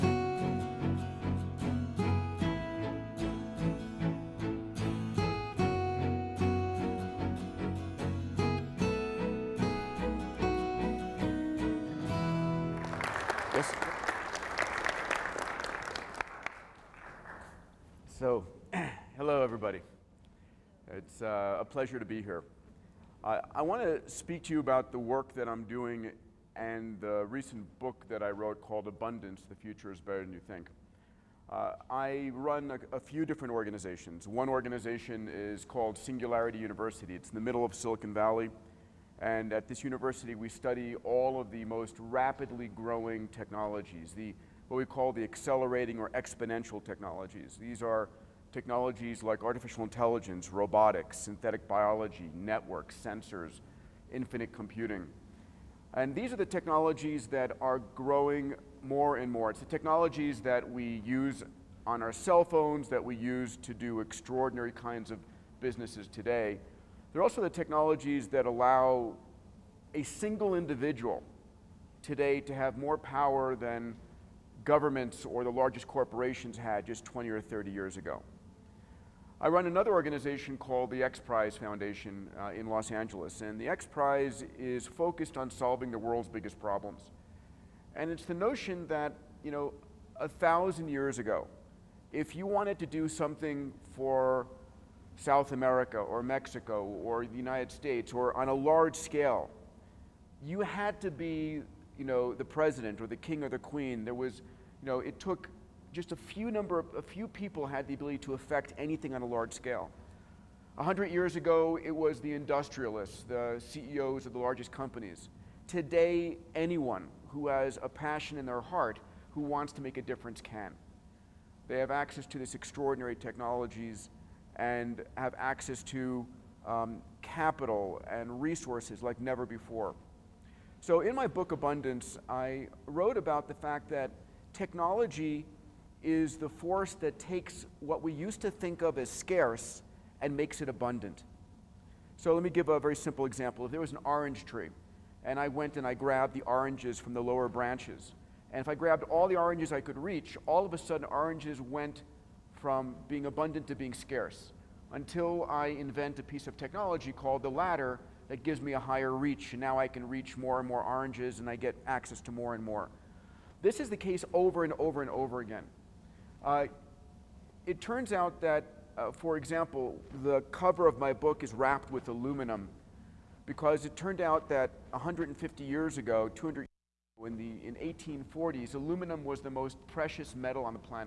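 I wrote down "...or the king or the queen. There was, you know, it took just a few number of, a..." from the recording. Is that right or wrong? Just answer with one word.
right.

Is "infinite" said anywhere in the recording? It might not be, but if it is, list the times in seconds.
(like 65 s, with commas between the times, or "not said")
54 s.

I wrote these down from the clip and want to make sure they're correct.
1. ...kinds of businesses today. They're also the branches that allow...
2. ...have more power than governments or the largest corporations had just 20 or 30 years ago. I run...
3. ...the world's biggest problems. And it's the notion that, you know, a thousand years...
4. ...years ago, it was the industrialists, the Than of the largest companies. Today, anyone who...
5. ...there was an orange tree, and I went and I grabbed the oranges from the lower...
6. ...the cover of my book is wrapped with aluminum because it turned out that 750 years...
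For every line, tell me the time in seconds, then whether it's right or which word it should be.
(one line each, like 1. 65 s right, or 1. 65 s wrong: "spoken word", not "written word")
1. 64 s wrong: "technologies", not "branches"
2. 72 s right
3. 85 s right
4. 111 s wrong: "CEOs", not "Than"
5. 143 s right
6. 170 s wrong: "150", not "750".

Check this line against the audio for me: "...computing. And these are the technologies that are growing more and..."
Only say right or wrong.
right.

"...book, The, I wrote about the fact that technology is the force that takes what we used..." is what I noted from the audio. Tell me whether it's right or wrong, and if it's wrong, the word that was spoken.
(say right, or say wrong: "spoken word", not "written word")
wrong: "Abundance", not "The".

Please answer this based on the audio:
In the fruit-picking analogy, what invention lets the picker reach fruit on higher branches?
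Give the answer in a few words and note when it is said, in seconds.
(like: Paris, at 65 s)
the ladder, at 157 s.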